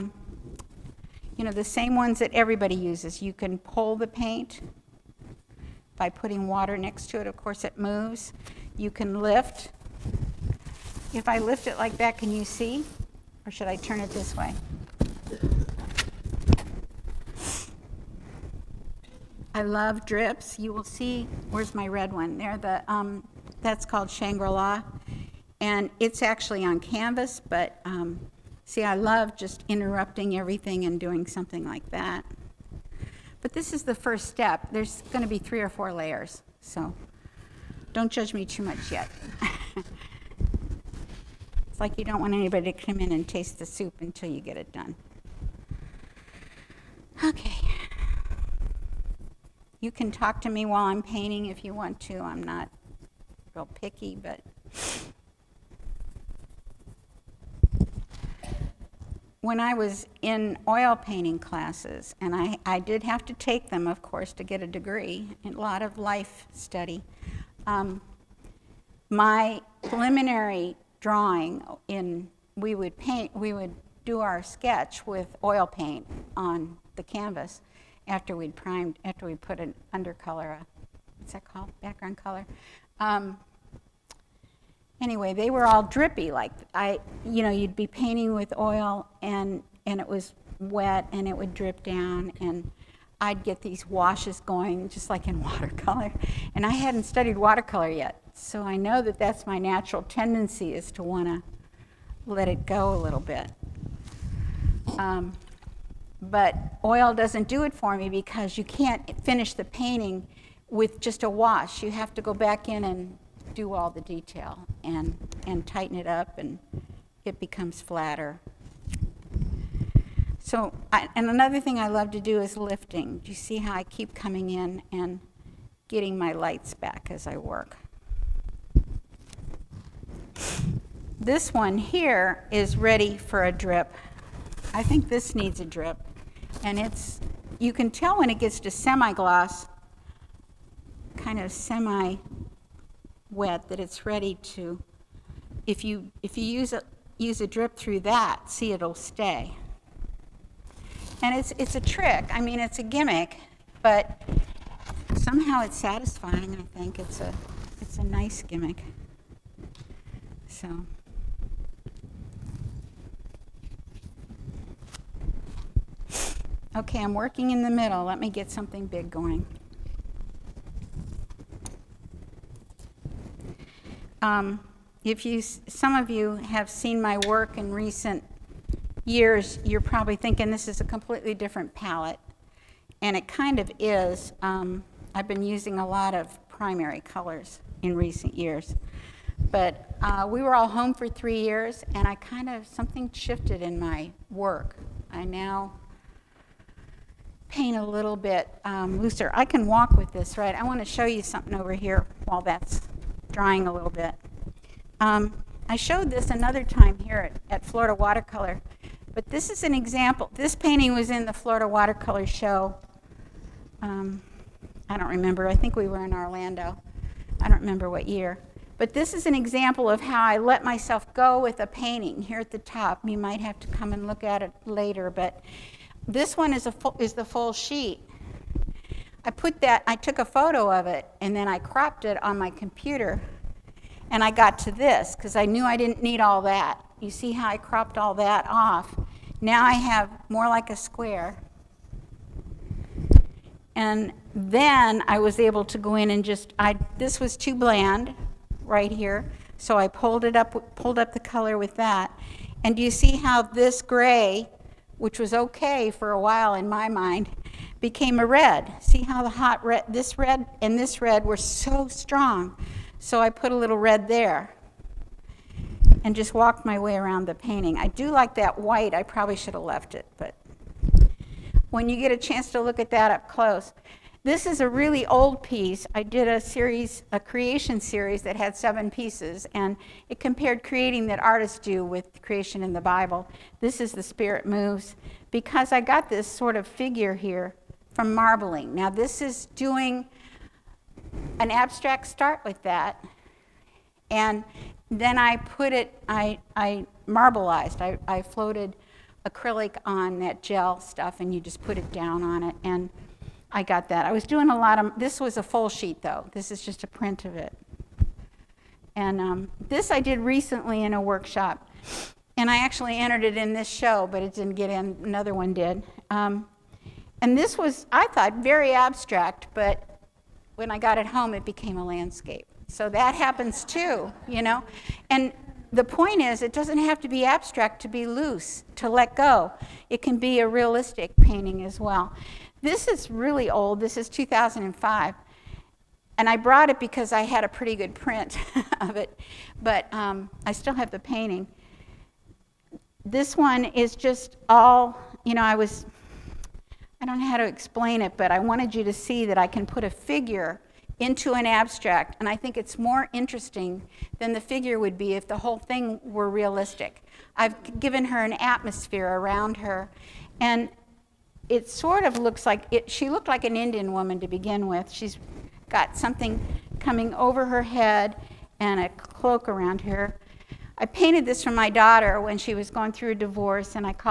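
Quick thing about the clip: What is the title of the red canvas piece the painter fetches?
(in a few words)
Shangri-La.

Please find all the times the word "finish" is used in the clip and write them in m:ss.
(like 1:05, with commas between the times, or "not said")
1:49.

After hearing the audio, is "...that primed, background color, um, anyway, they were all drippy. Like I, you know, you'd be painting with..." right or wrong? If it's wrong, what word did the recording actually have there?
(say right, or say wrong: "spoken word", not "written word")
wrong: "called", not "primed".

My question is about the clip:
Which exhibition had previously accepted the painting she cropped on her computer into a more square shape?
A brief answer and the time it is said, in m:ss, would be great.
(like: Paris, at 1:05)
Florida Watercolor show, at 3:31.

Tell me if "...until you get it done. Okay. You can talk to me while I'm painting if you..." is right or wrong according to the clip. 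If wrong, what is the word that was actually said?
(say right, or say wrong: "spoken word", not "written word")
right.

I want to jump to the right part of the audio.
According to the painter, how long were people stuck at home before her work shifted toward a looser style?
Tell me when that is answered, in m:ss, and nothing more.
3:11.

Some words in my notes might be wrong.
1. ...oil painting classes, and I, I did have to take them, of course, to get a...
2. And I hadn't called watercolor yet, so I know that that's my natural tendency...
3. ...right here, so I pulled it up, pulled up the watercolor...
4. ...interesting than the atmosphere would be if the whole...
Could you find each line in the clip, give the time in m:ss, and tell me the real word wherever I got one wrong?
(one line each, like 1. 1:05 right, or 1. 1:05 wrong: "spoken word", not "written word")
1. 1:00 right
2. 1:36 wrong: "studied", not "called"
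3. 4:08 wrong: "color", not "watercolor"
4. 5:53 wrong: "figure", not "atmosphere".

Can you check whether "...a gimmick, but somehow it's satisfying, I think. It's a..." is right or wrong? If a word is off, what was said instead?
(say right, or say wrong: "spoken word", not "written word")
right.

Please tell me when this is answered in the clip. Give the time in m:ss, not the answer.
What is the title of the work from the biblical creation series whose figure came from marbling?
4:43.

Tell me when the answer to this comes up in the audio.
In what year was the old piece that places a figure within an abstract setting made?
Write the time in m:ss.
5:34.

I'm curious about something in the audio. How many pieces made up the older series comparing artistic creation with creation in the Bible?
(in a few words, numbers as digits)
7.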